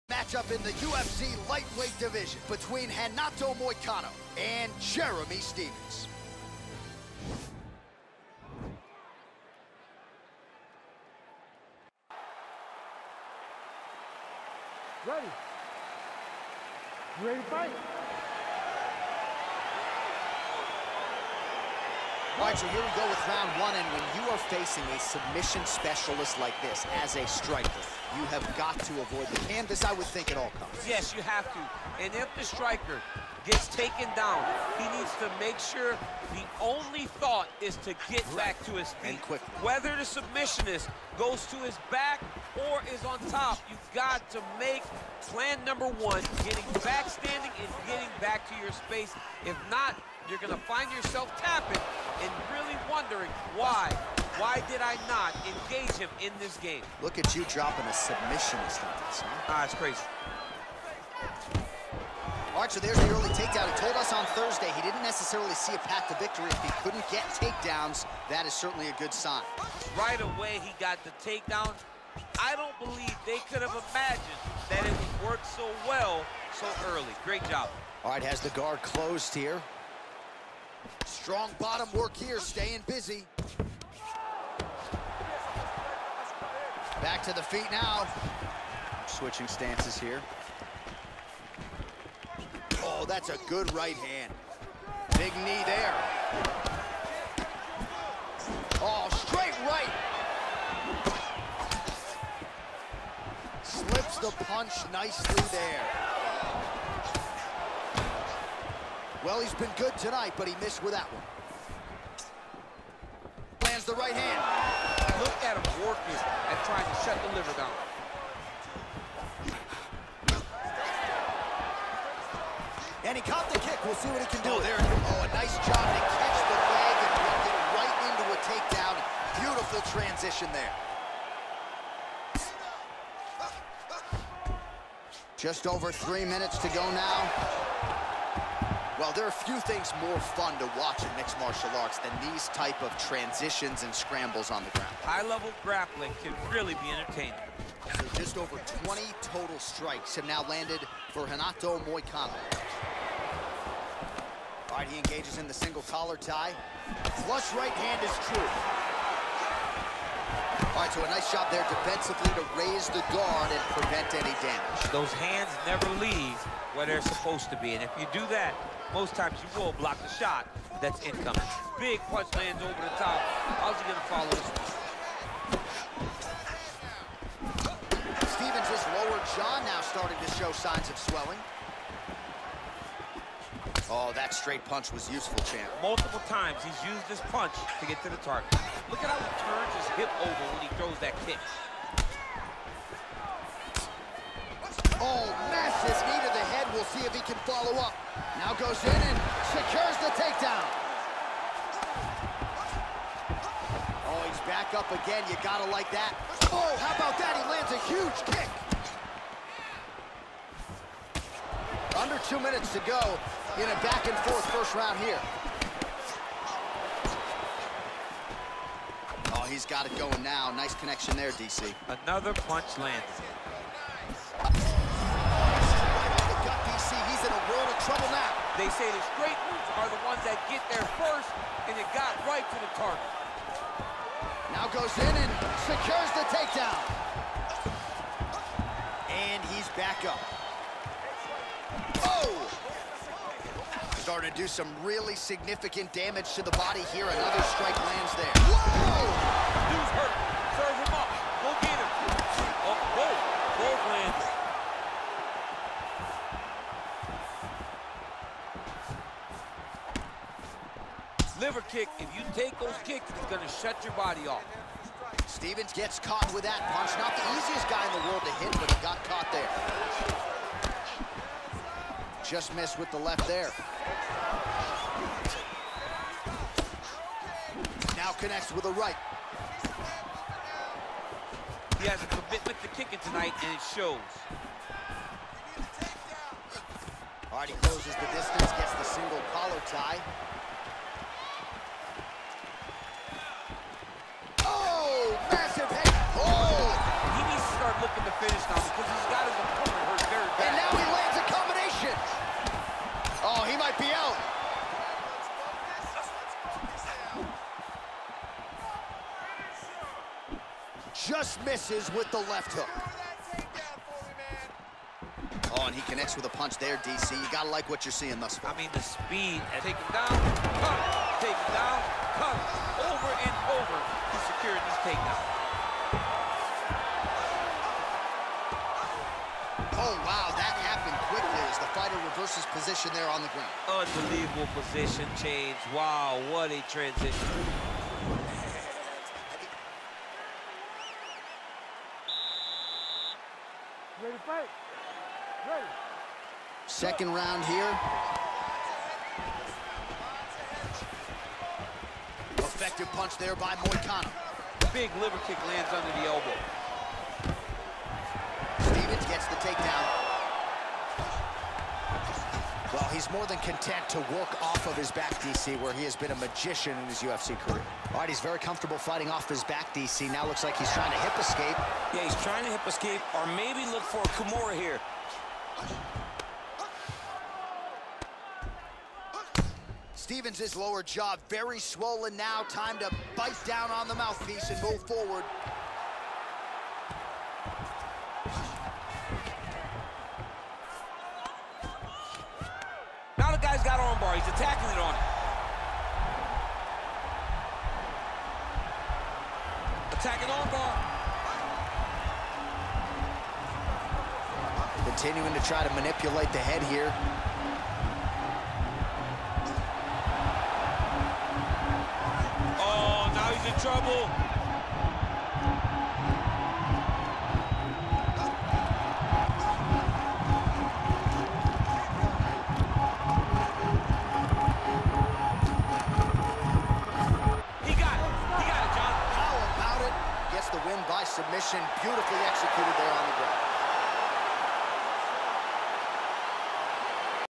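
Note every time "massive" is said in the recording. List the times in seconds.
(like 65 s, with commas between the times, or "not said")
195 s, 295 s.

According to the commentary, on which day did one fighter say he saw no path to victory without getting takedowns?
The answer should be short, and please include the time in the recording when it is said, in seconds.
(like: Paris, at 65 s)
Thursday, at 64 s.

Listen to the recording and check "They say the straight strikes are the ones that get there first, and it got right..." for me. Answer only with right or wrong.
wrong.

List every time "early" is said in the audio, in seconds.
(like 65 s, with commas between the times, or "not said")
63 s, 76 s.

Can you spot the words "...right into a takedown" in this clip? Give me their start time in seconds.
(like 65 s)
127 s.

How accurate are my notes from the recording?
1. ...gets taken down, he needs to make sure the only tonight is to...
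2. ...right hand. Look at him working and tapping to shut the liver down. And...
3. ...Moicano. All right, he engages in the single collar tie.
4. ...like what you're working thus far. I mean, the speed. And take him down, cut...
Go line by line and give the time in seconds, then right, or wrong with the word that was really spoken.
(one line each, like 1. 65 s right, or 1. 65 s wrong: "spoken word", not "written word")
1. 33 s wrong: "thought", not "tonight"
2. 113 s wrong: "trying", not "tapping"
3. 151 s right
4. 317 s wrong: "seeing", not "working".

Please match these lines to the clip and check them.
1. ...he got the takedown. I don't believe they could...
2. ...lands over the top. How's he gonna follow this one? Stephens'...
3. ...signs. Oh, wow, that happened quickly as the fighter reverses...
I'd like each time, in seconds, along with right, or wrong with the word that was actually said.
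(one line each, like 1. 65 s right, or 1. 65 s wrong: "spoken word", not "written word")
1. 70 s right
2. 172 s right
3. 324 s wrong: "takedowns", not "signs".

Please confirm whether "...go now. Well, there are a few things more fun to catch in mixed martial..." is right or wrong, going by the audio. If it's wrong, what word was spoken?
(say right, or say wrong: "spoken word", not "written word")
wrong: "watch", not "catch".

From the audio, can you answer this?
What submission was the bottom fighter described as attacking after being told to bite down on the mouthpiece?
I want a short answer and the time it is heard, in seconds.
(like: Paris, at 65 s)
Armbar, at 400 s.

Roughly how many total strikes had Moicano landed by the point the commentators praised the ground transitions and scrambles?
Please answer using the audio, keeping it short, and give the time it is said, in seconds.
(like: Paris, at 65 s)
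Just over 20, at 148 s.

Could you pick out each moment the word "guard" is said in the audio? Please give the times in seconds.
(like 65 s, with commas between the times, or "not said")
78 s, 163 s.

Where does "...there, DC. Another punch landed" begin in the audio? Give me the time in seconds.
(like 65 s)
221 s.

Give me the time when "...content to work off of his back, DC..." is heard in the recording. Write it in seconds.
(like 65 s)
363 s.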